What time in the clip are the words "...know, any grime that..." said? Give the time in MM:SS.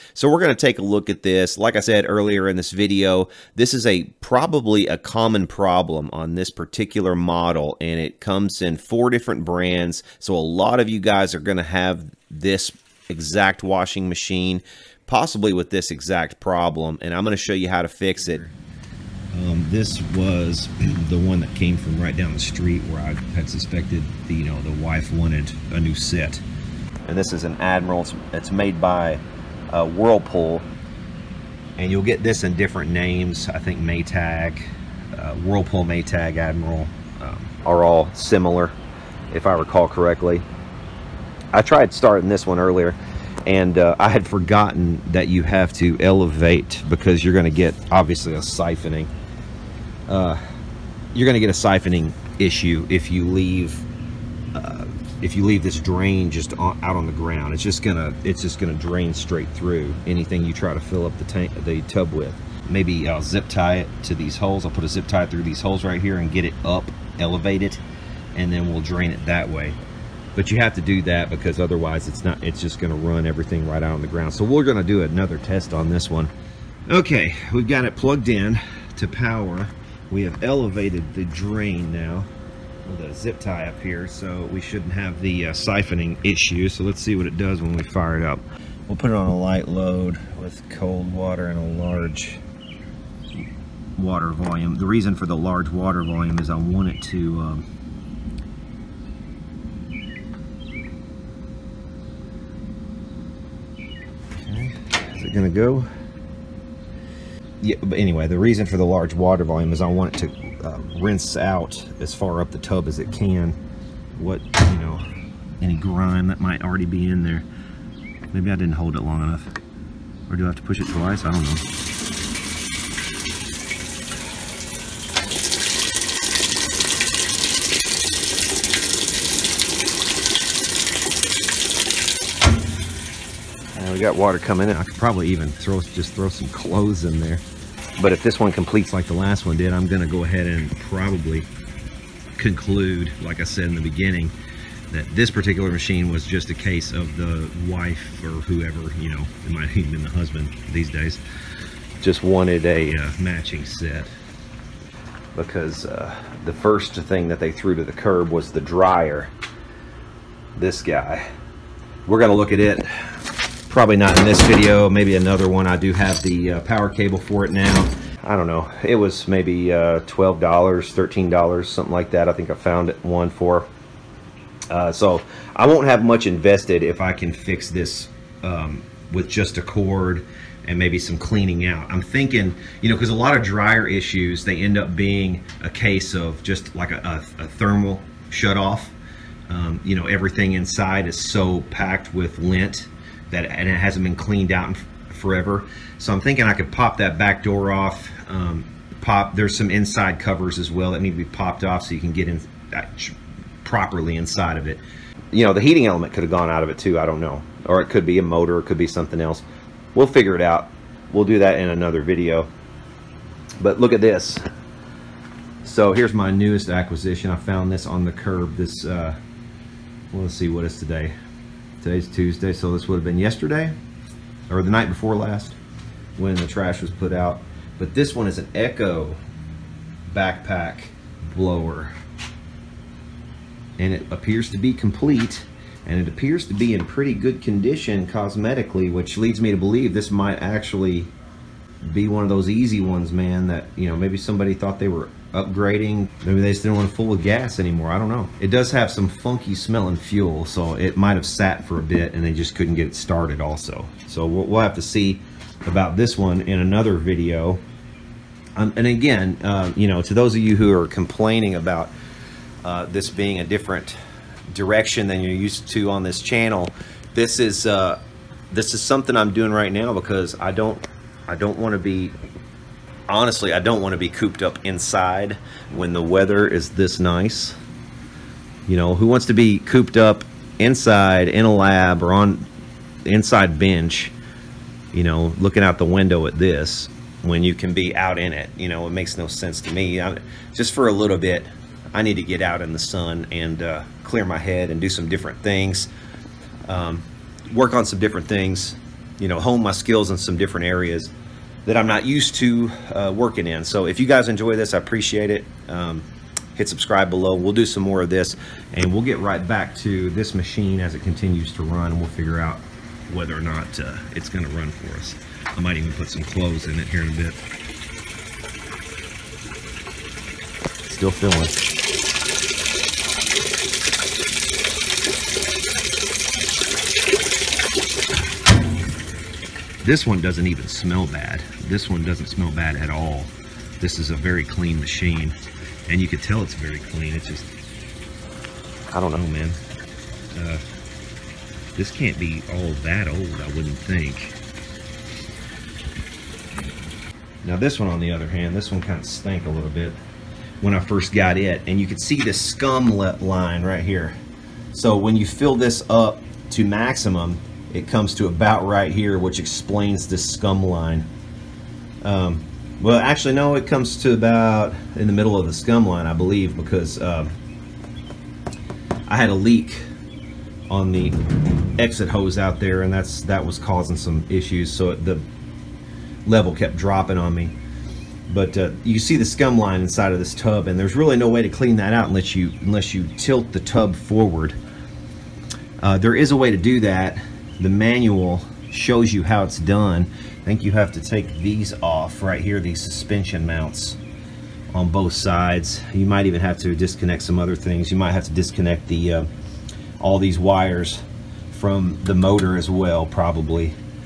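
01:54.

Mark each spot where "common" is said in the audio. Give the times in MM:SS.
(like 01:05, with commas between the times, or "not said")
00:04.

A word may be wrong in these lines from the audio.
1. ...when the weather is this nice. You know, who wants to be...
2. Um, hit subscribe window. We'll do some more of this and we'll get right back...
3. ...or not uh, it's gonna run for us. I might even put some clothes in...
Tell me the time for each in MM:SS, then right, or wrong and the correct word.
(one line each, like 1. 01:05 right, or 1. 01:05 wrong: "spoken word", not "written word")
1. 04:35 right
2. 05:05 wrong: "below", not "window"
3. 05:13 right.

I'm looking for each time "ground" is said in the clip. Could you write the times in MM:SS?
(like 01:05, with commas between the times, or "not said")
00:57, 01:14.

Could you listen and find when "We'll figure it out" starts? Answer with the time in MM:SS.
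03:29.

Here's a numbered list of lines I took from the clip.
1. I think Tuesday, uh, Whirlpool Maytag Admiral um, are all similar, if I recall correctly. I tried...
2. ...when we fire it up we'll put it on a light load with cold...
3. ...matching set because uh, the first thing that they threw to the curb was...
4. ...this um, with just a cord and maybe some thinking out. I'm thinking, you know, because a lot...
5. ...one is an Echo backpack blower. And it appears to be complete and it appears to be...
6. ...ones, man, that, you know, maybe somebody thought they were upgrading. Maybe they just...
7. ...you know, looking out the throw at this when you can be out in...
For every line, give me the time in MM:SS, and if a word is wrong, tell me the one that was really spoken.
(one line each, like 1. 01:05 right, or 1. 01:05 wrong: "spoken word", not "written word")
1. 00:33 wrong: "Maytag", not "Tuesday"
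2. 01:27 right
3. 02:33 right
4. 02:57 wrong: "cleaning", not "thinking"
5. 03:48 right
6. 04:02 right
7. 04:44 wrong: "window", not "throw".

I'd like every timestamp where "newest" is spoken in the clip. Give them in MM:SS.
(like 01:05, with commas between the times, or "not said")
03:36.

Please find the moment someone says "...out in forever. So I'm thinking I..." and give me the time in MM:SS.
03:14.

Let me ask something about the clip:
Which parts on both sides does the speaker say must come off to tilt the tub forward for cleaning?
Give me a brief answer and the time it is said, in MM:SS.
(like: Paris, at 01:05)
suspension mounts, at 06:32.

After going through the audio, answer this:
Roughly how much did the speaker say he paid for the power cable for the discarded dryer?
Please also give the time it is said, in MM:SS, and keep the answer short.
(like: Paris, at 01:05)
$12 to $13, at 02:50.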